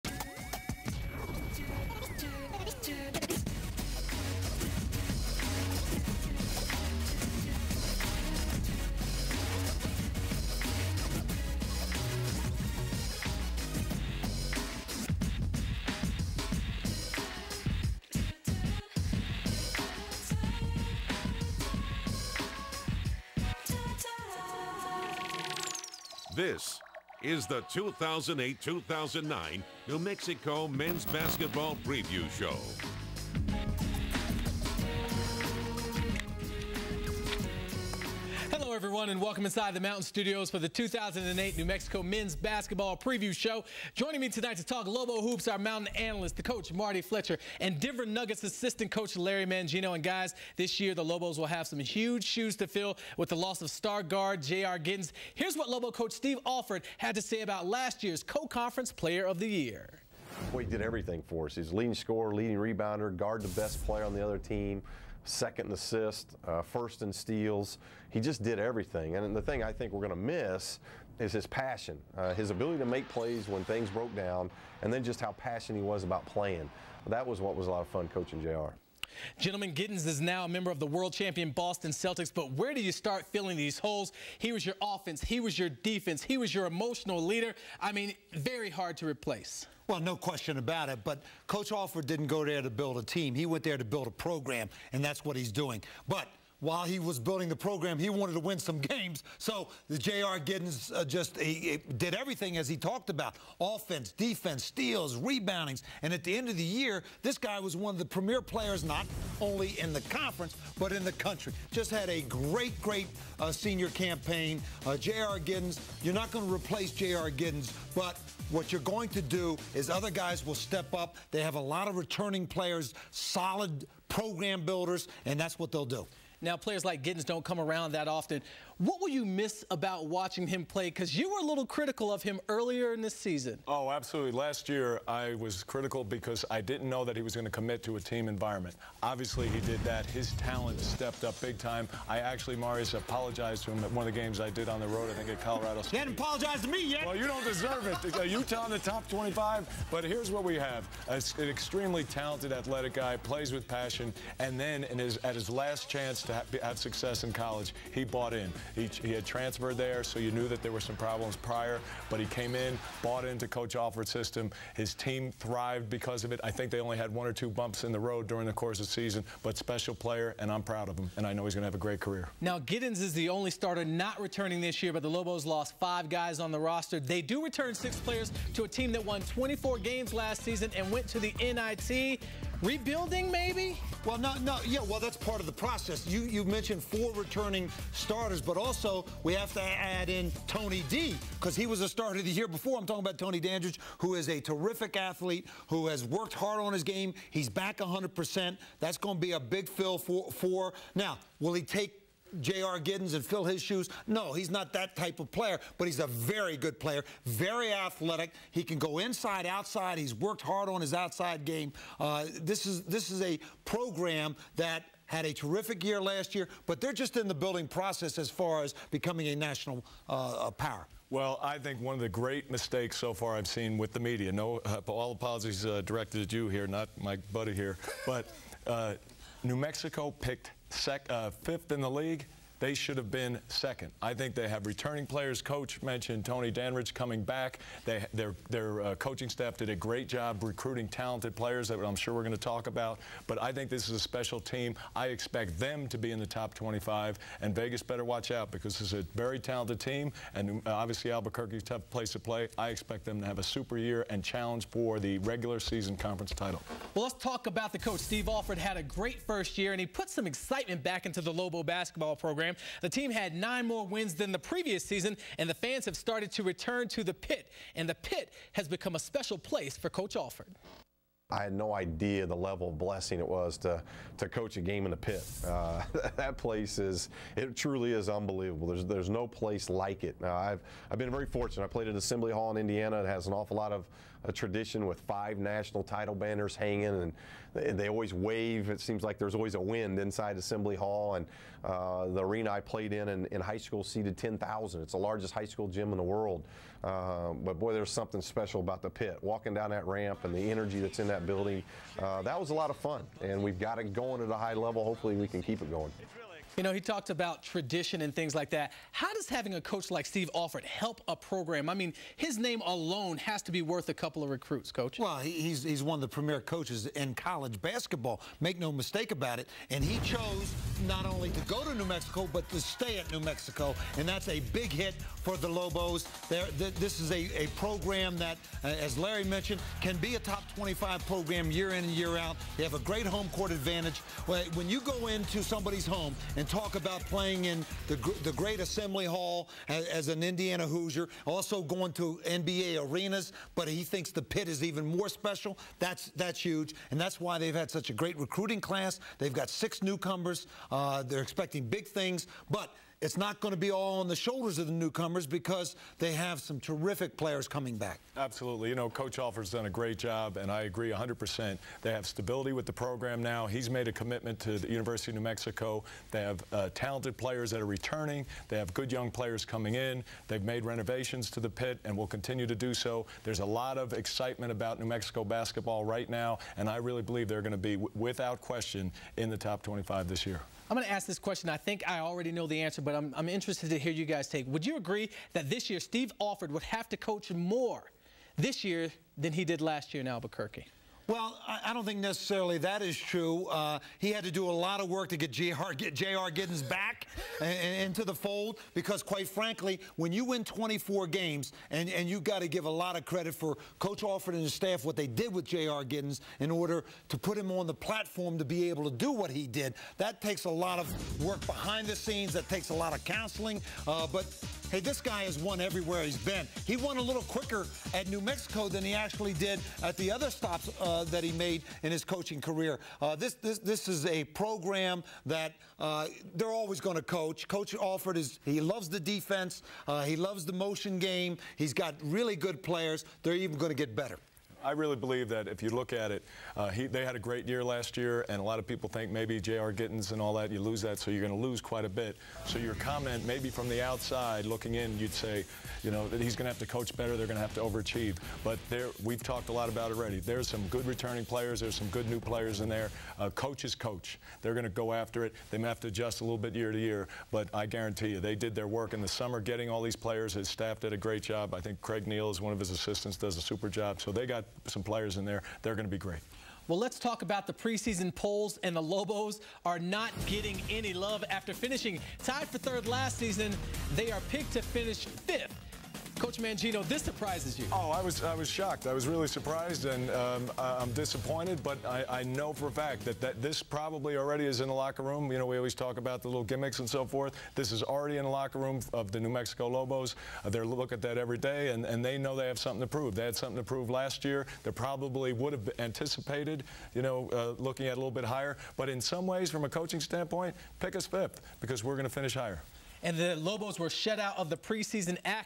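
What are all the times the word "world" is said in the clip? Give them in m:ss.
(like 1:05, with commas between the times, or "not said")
1:20, 4:56.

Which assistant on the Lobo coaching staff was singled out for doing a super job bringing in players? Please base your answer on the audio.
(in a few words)
Craig Neal.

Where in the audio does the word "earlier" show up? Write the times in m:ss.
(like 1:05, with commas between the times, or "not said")
2:12.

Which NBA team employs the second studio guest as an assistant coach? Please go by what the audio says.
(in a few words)
Denver Nuggets.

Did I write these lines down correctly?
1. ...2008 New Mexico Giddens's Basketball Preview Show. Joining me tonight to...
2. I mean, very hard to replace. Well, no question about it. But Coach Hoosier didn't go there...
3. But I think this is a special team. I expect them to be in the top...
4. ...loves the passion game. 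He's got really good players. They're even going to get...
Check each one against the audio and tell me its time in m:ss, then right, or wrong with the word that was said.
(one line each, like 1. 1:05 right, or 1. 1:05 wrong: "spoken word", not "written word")
1. 0:40 wrong: "Men", not "Giddens"
2. 1:27 wrong: "Alford", not "Hoosier"
3. 4:03 right
4. 7:10 wrong: "motion", not "passion".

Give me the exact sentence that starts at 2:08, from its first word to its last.
What will you miss about watching him play?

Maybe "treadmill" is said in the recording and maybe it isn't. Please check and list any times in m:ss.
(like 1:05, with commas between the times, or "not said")
not said.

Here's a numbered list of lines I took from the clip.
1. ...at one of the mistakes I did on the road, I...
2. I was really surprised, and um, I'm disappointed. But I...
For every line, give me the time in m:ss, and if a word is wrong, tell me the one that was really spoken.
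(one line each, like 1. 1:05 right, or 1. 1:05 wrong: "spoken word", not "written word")
1. 2:23 wrong: "games", not "mistakes"
2. 7:58 right.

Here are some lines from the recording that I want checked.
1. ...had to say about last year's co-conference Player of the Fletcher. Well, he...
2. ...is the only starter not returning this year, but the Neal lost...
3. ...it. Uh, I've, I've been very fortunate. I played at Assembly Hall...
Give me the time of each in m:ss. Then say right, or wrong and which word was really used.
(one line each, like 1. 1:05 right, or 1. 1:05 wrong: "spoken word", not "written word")
1. 0:56 wrong: "Year", not "Fletcher"
2. 2:53 wrong: "Lobos", not "Neal"
3. 4:40 right.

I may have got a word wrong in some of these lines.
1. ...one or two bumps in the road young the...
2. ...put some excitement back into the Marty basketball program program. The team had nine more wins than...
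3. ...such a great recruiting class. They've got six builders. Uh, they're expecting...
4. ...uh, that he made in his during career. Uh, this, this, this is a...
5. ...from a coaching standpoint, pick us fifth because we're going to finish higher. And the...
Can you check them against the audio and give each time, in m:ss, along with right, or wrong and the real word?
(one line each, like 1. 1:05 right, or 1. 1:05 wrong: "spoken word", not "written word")
1. 2:47 wrong: "during", not "young"
2. 4:19 wrong: "Lobo", not "Marty"
3. 5:47 wrong: "newcomers", not "builders"
4. 7:00 wrong: "coaching", not "during"
5. 8:19 right.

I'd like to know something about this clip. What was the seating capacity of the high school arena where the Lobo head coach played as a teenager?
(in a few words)
10,000.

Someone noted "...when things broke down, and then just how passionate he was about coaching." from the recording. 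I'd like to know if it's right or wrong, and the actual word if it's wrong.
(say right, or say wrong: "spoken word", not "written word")
wrong: "playing", not "coaching".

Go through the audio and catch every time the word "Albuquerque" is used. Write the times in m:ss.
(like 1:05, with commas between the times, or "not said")
4:11, 6:30.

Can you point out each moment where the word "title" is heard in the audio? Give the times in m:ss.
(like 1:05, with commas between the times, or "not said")
4:16, 4:45.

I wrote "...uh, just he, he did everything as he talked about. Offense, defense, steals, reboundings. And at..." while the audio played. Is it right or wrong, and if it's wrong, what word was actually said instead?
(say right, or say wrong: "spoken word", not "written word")
right.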